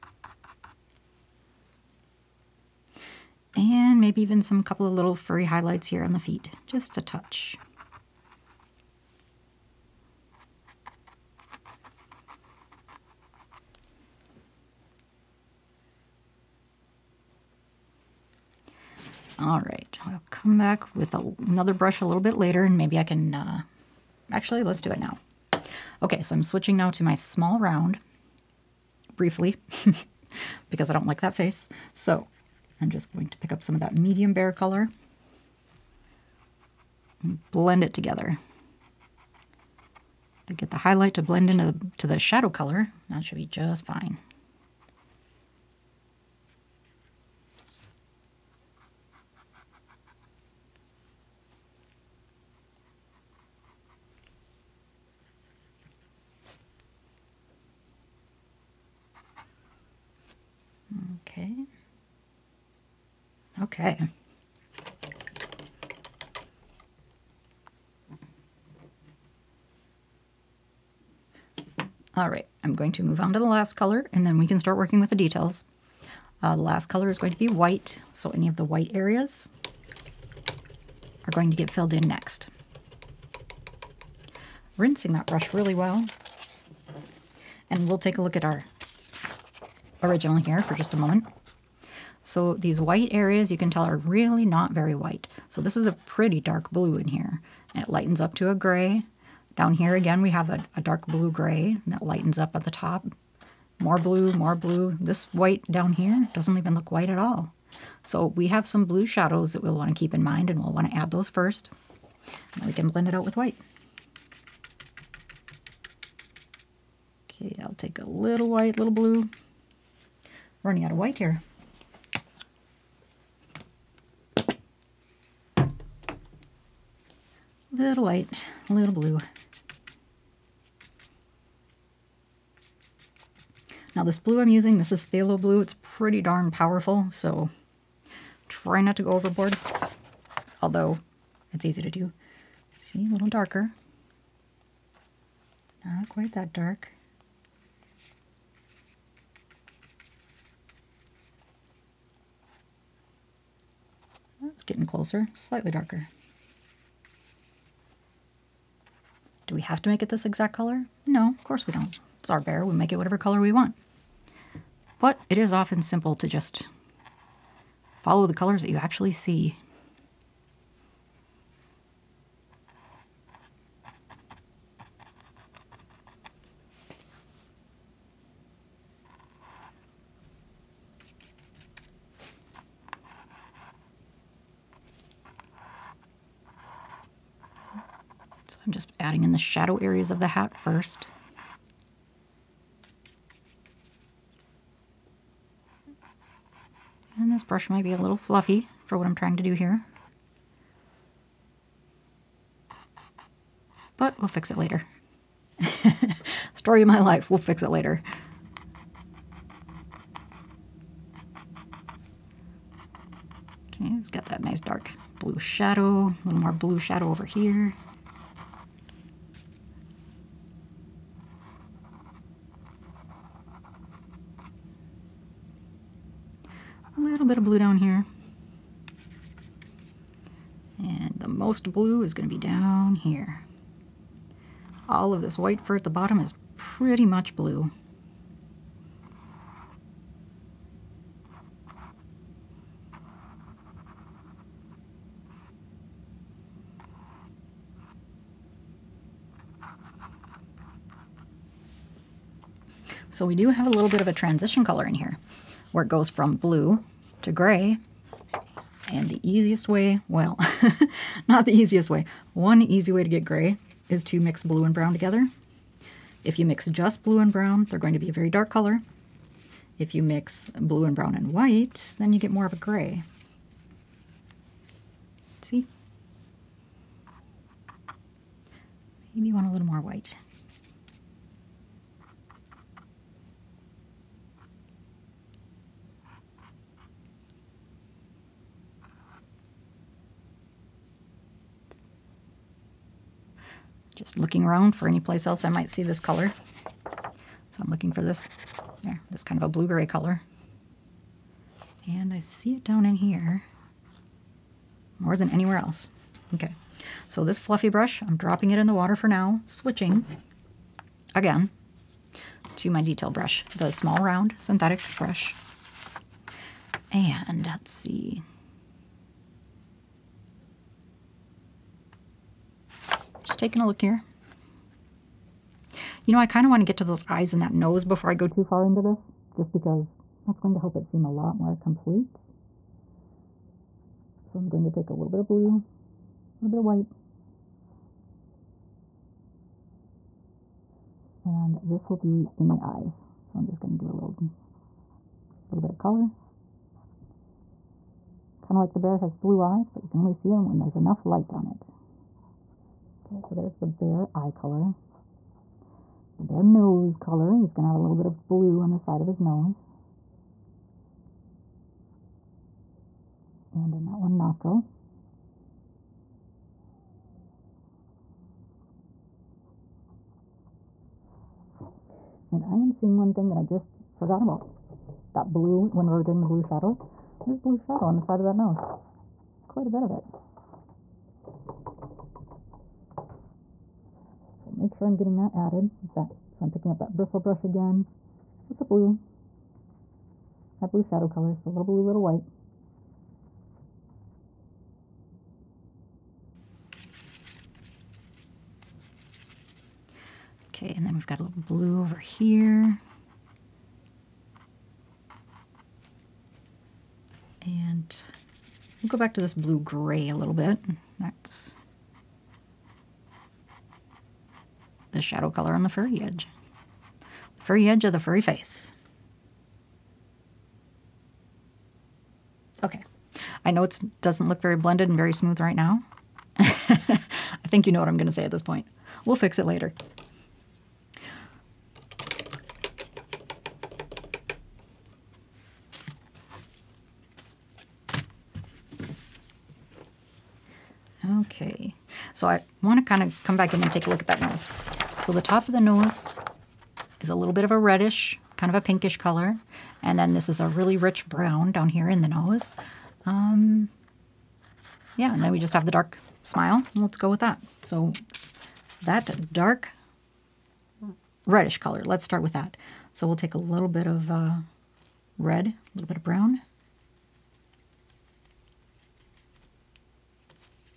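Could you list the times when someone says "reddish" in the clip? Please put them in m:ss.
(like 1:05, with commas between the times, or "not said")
7:27, 7:41.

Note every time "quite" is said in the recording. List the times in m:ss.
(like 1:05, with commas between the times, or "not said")
2:26, 6:19.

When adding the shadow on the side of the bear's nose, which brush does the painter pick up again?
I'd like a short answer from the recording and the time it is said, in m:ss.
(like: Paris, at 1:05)
bristle brush, at 6:26.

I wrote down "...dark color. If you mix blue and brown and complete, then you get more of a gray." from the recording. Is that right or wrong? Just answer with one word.
wrong.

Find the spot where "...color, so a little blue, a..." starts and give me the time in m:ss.
6:31.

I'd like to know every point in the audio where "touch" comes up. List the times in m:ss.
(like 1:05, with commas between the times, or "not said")
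0:07.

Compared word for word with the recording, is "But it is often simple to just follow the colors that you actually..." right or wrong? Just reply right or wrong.
right.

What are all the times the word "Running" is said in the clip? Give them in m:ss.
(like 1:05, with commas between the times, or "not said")
2:00.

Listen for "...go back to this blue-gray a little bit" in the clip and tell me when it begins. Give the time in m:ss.
6:48.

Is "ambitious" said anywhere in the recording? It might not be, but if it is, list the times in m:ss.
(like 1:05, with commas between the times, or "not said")
not said.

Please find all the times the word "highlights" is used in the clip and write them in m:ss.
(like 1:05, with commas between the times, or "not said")
0:05, 0:40.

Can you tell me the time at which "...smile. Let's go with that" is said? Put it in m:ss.
7:36.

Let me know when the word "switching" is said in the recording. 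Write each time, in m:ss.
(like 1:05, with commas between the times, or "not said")
0:26, 5:09.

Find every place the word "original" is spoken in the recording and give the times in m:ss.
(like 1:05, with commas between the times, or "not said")
1:30.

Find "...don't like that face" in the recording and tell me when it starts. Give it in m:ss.
0:30.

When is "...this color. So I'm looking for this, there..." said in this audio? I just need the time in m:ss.
4:55.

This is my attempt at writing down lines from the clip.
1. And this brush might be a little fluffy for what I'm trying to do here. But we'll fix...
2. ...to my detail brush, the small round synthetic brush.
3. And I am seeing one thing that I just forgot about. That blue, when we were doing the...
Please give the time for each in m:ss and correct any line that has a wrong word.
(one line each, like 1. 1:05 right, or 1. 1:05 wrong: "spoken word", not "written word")
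1. 3:17 right
2. 5:12 right
3. 6:12 right.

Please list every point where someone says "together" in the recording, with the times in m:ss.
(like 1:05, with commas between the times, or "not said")
0:37, 4:24.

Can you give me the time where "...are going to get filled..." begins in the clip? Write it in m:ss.
1:21.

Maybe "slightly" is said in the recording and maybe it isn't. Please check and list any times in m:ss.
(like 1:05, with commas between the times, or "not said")
2:35.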